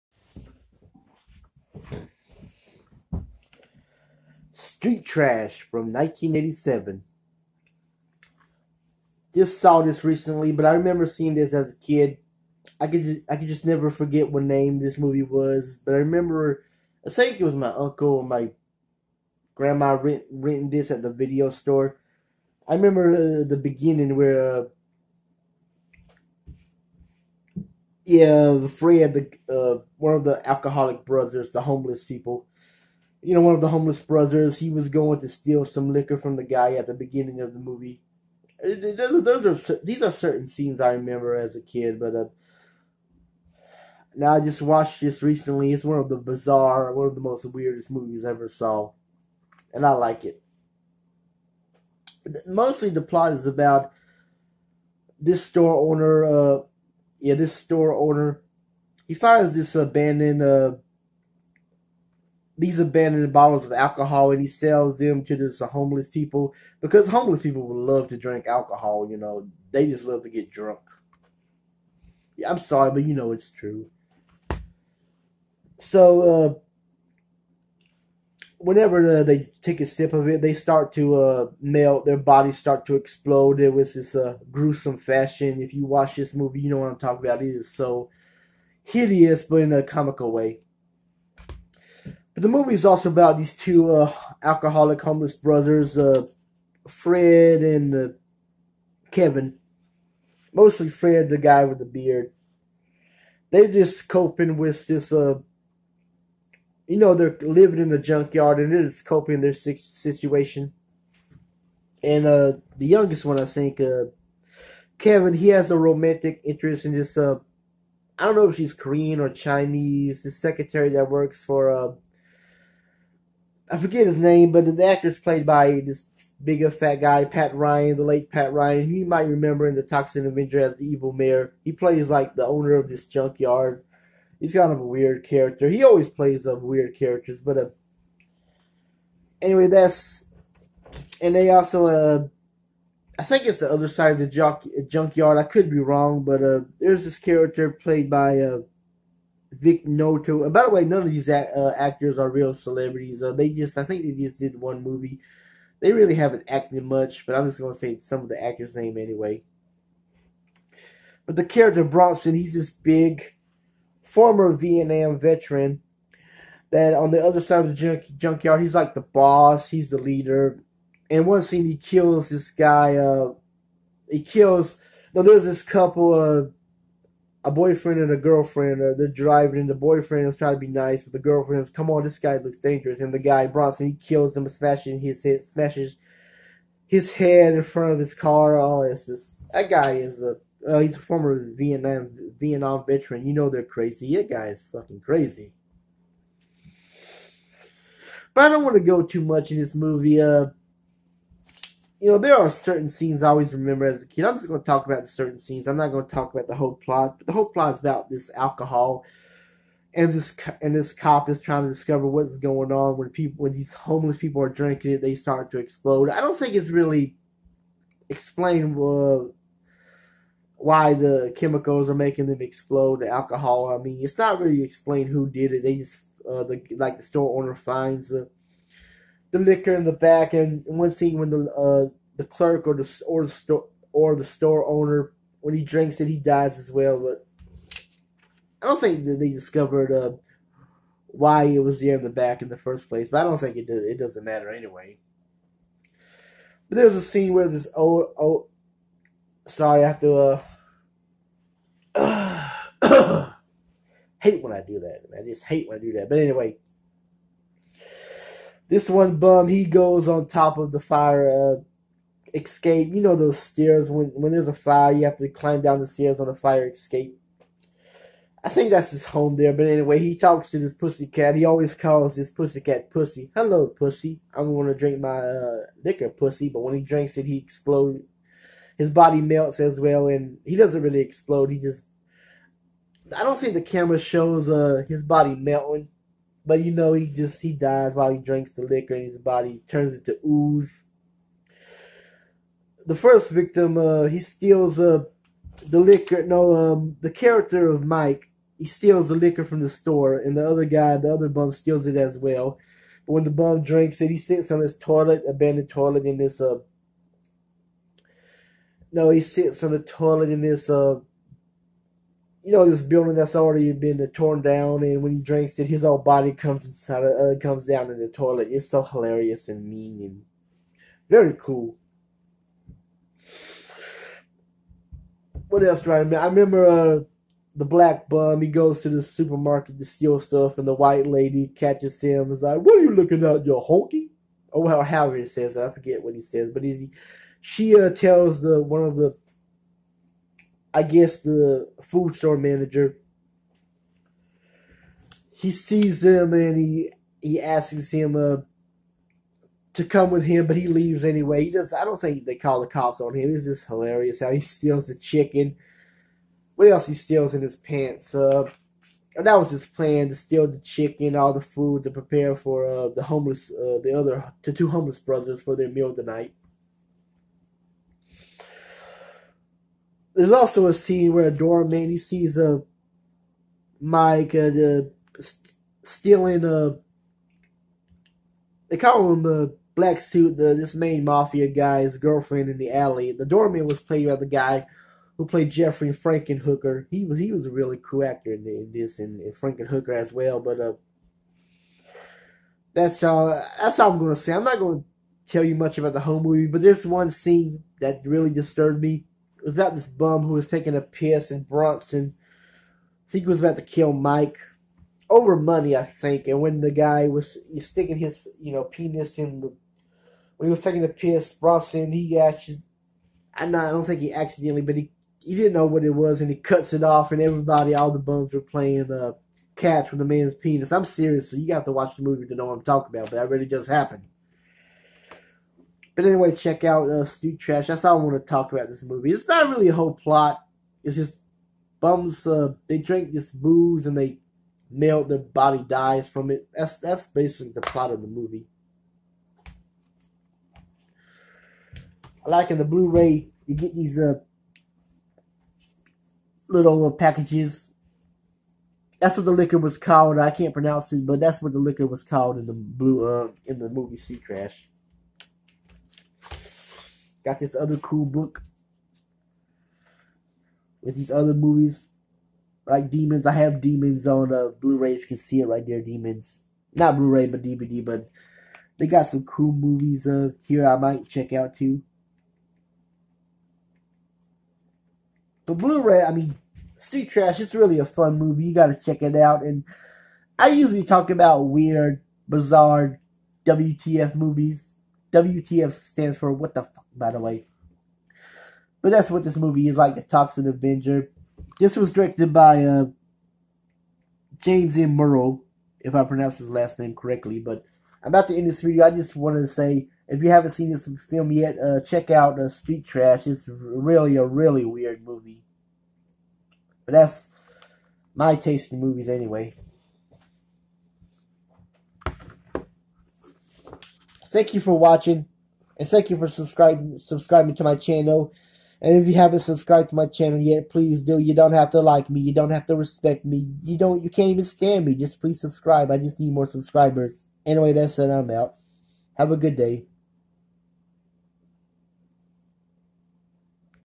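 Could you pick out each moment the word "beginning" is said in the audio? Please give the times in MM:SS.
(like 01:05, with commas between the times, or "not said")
00:23, 00:36.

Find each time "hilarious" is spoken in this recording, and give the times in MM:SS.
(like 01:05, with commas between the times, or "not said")
05:18, 05:53.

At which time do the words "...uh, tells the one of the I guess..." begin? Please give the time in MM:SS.
05:37.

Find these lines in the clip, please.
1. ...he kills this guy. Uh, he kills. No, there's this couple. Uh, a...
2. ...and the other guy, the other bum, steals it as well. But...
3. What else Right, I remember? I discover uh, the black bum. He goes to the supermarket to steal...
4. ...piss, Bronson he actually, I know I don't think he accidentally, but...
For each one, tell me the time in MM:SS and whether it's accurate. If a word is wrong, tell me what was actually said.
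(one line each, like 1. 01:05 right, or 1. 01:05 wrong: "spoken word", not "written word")
1. 02:51 right
2. 05:00 right
3. 05:25 wrong: "remember", not "discover"
4. 06:50 right.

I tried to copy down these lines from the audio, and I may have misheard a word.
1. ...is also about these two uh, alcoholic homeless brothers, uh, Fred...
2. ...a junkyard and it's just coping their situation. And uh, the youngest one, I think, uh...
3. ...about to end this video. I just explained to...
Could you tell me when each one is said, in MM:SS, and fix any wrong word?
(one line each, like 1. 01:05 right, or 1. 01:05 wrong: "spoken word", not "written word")
1. 01:32 right
2. 01:47 right
3. 08:18 wrong: "wanted", not "explained".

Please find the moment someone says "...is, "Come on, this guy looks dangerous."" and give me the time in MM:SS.
03:01.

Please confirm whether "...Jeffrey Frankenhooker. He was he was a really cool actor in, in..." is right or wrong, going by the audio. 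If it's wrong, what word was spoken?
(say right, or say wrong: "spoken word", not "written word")
right.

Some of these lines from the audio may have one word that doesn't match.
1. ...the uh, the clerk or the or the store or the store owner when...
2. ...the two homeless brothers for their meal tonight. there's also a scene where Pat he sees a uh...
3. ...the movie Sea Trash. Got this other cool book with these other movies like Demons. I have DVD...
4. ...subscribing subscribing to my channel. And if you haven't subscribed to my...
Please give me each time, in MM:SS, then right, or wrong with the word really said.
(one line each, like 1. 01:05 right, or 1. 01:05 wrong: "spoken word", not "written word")
1. 03:51 right
2. 06:04 wrong: "Dora", not "Pat"
3. 07:33 wrong: "Demons", not "DVD"
4. 08:36 right.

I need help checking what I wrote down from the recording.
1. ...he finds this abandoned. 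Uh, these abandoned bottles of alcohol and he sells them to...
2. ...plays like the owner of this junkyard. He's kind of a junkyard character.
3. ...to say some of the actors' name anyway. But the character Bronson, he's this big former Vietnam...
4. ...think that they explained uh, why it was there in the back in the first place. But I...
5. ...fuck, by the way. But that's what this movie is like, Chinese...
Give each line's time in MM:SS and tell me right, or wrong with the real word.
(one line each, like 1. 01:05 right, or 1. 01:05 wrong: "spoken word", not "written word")
1. 00:59 right
2. 02:11 wrong: "weird", not "junkyard"
3. 02:37 right
4. 03:58 wrong: "discovered", not "explained"
5. 08:06 wrong: "The", not "Chinese".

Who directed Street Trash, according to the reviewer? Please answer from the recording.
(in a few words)
James M. Muro.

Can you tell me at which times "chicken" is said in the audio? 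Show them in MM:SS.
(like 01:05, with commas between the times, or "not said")
05:54, 06:00.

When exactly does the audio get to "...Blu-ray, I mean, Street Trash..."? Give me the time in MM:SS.
07:55.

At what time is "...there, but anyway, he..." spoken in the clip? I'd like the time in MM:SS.
04:29.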